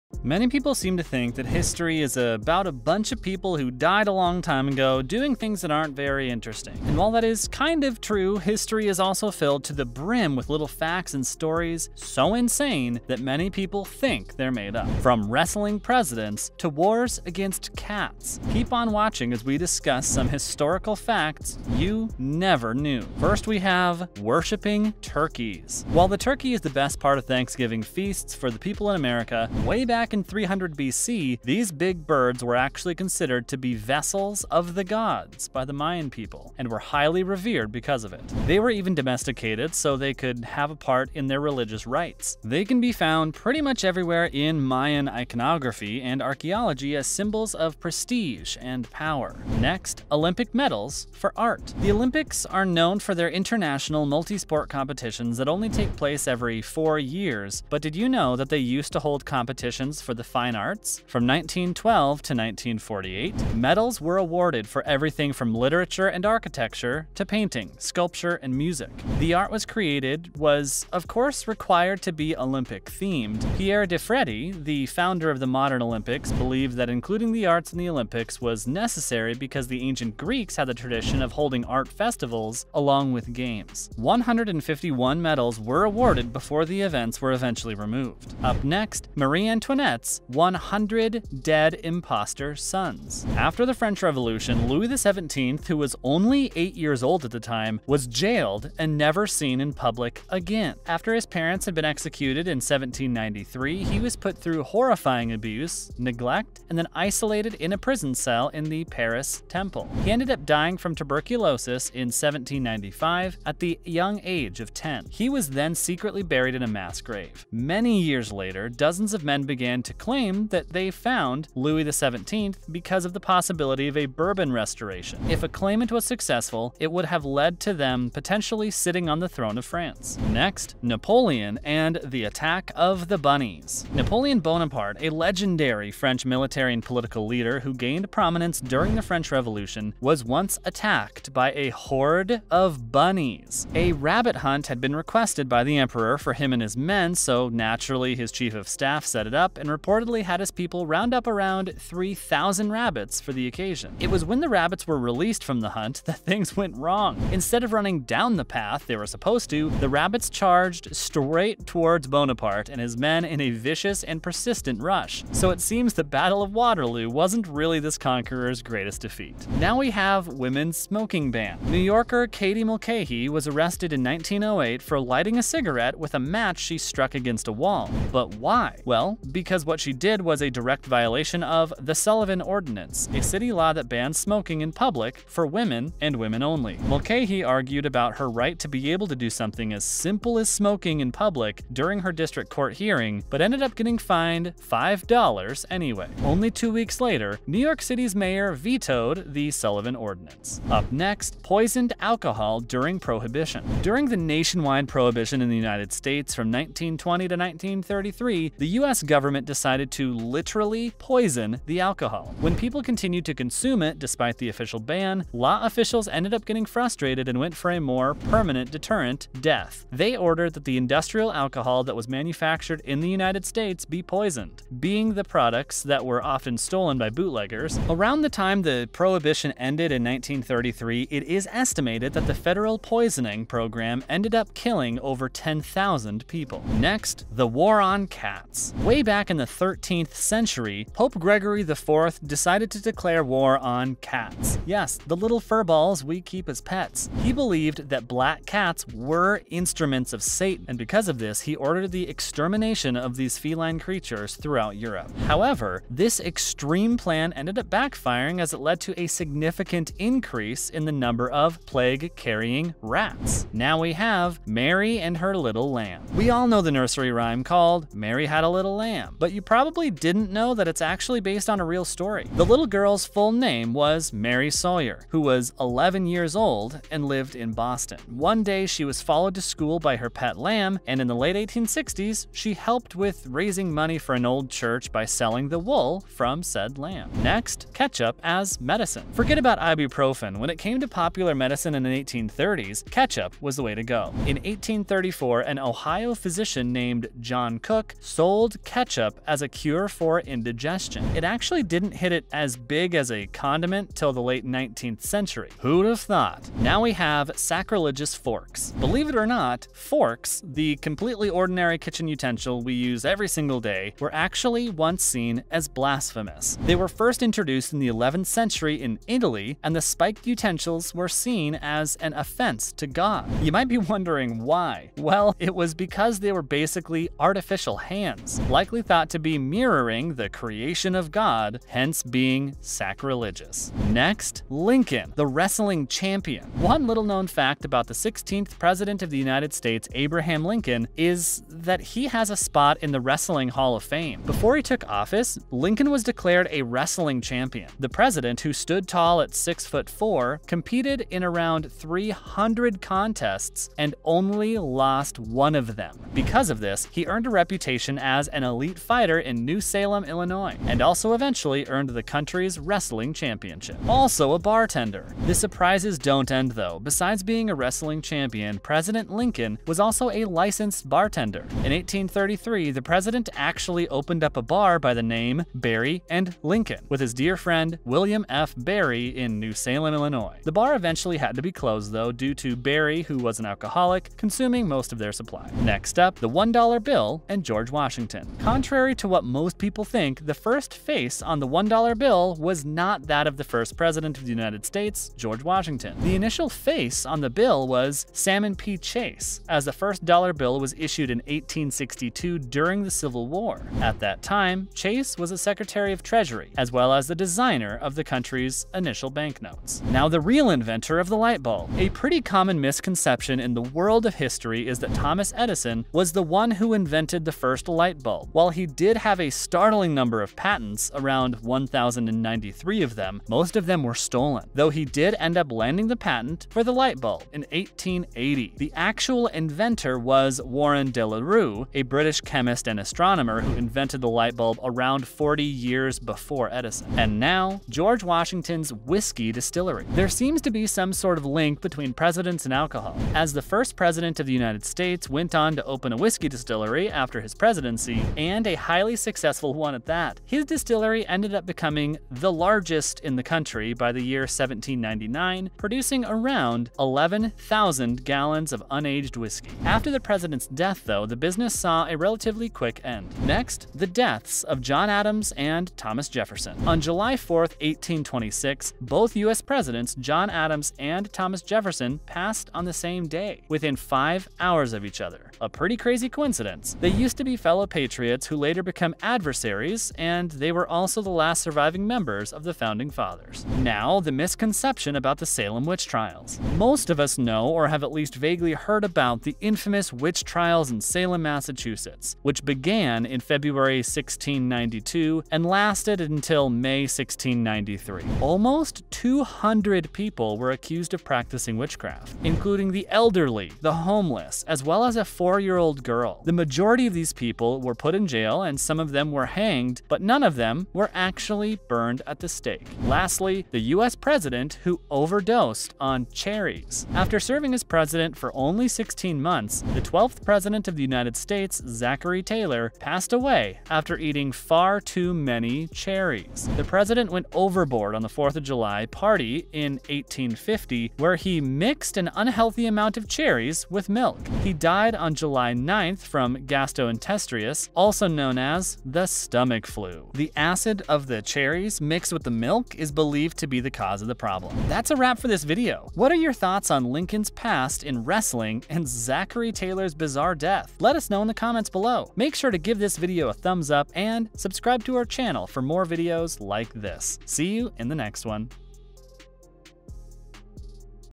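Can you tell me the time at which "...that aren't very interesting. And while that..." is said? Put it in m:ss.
0:05.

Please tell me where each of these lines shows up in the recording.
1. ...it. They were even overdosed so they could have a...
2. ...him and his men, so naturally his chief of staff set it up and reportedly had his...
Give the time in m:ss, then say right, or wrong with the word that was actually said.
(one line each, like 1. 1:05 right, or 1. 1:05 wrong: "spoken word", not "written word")
1. 0:38 wrong: "domesticated", not "overdosed"
2. 2:26 right.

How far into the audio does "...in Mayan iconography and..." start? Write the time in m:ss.
0:44.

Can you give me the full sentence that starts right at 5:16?
They were first introduced in the 11th century in Italy, and the spiked utensils were seen as an offense to God.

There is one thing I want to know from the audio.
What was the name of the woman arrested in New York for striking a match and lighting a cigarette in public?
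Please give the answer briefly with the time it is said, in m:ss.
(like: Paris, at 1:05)
Katie Mulcahy, at 2:52.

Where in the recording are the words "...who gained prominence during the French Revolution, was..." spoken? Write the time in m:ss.
2:17.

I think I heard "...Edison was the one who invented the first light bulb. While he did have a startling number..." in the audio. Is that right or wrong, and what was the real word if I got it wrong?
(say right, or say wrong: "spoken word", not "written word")
right.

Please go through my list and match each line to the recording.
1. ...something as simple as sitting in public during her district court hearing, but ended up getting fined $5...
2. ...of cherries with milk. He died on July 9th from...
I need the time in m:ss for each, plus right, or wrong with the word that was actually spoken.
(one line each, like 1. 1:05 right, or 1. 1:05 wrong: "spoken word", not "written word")
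1. 3:09 wrong: "smoking", not "sitting"
2. 8:52 right.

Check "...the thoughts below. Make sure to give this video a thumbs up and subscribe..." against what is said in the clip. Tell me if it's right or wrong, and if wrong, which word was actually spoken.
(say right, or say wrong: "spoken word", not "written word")
wrong: "comments", not "thoughts".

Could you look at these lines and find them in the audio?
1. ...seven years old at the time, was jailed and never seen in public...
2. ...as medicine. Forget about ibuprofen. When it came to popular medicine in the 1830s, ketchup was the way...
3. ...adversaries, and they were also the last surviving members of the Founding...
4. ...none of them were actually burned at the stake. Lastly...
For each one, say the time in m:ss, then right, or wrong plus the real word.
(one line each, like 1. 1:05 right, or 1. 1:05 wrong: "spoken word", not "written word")
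1. 1:36 wrong: "eight", not "seven"
2. 4:48 right
3. 7:59 right
4. 8:30 right.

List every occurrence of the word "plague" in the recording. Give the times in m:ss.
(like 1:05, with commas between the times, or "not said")
4:21.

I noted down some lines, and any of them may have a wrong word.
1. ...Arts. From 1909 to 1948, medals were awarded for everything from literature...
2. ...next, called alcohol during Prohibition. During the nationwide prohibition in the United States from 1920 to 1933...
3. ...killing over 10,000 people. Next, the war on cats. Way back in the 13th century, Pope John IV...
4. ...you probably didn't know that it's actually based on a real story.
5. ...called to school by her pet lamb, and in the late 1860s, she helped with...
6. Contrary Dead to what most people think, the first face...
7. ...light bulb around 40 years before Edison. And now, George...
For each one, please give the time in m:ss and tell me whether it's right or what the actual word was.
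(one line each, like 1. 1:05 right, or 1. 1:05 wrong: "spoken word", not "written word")
1. 1:00 wrong: "1912", not "1909"
2. 3:20 wrong: "poisoned", not "called"
3. 3:54 wrong: "Gregory", not "John"
4. 4:29 right
5. 4:39 wrong: "followed", not "called"
6. 6:28 wrong: "Contrary", not "Dead"
7. 7:14 right.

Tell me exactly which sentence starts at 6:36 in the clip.
The initial face on the bill was Salmon P.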